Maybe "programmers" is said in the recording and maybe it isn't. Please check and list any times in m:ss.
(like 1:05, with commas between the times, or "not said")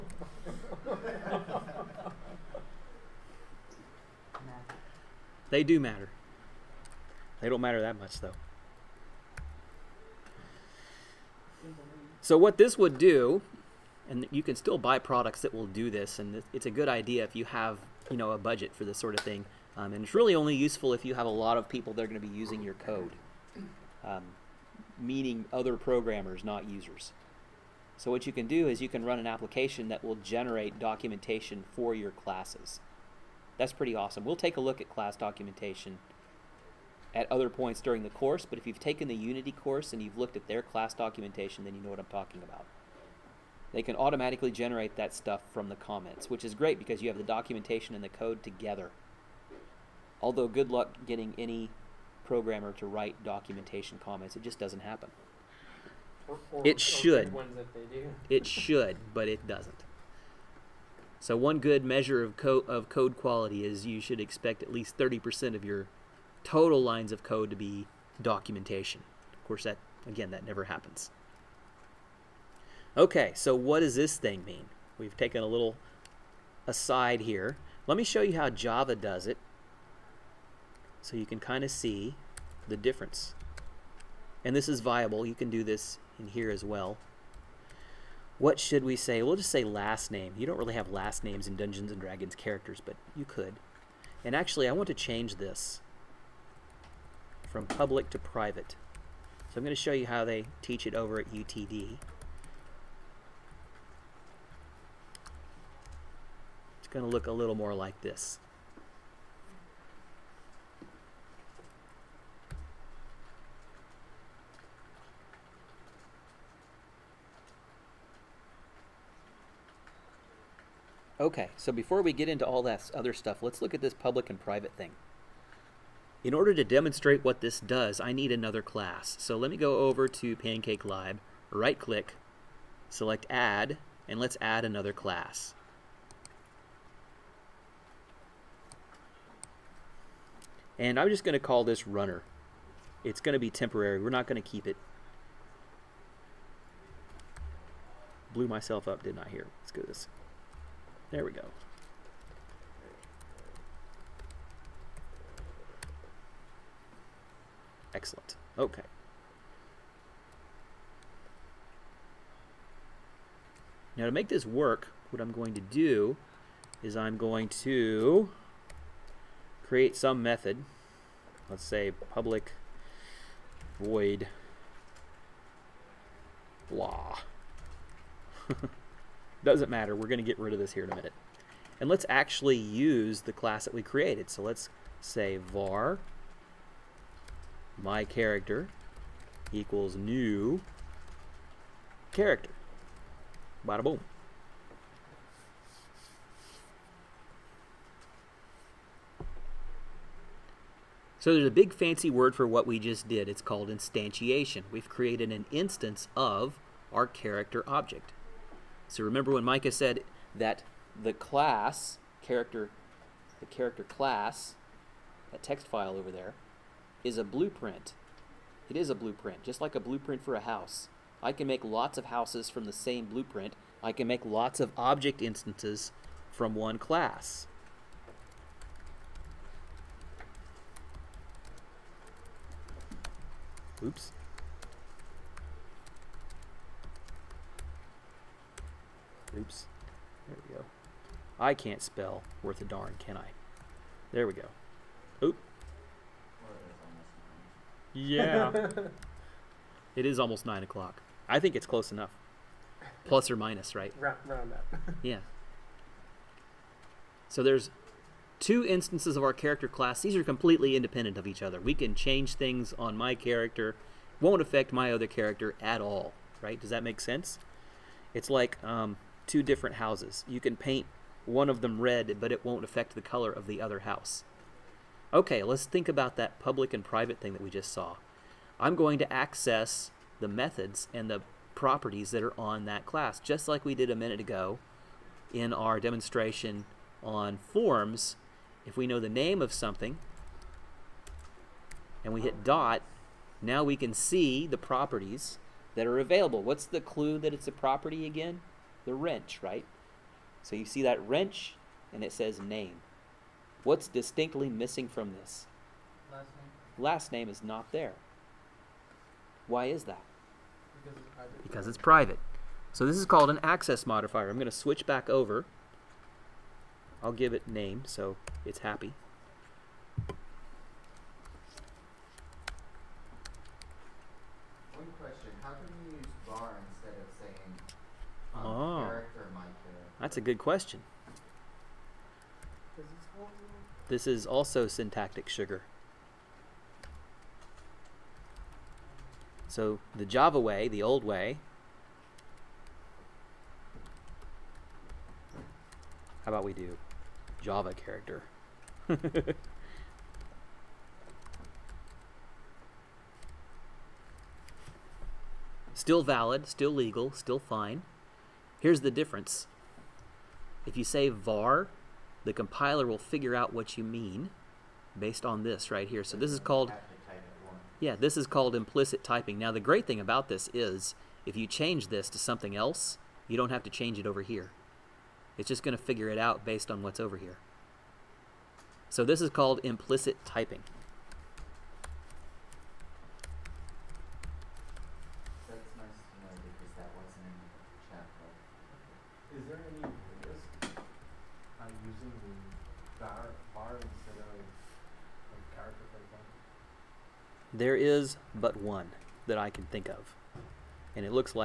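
0:25, 0:52.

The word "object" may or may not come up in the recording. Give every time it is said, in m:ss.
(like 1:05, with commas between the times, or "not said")
3:27, 3:44.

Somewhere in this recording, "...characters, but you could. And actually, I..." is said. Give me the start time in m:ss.
1:32.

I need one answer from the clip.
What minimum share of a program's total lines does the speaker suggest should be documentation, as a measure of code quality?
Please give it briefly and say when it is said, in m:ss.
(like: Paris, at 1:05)
30%, at 1:04.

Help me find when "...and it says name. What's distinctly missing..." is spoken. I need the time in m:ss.
5:01.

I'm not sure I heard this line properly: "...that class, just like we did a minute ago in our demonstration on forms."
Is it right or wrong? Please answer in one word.
right.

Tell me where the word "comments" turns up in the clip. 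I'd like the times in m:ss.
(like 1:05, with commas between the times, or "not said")
0:45, 0:53.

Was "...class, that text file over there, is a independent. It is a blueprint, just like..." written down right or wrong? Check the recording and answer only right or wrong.
wrong.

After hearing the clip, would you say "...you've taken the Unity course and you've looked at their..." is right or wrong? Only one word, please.
right.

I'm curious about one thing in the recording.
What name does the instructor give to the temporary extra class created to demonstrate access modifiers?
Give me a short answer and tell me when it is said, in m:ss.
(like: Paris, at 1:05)
Runner, at 2:21.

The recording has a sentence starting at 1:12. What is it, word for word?
Okay, so what does this thing mean?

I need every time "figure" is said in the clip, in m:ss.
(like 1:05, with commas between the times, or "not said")
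6:02, 6:15.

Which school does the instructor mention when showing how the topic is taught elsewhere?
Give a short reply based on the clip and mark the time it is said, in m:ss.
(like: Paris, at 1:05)
UTD, at 1:41.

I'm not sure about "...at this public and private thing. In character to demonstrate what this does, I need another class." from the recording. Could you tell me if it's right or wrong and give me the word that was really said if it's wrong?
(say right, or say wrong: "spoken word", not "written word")
wrong: "order", not "character".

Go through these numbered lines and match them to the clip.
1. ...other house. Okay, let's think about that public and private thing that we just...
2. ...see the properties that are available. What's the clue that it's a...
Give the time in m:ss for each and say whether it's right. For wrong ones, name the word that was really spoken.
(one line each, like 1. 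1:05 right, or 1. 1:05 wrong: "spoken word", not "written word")
1. 4:33 right
2. 4:53 right.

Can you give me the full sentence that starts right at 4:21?
We can change things on my character.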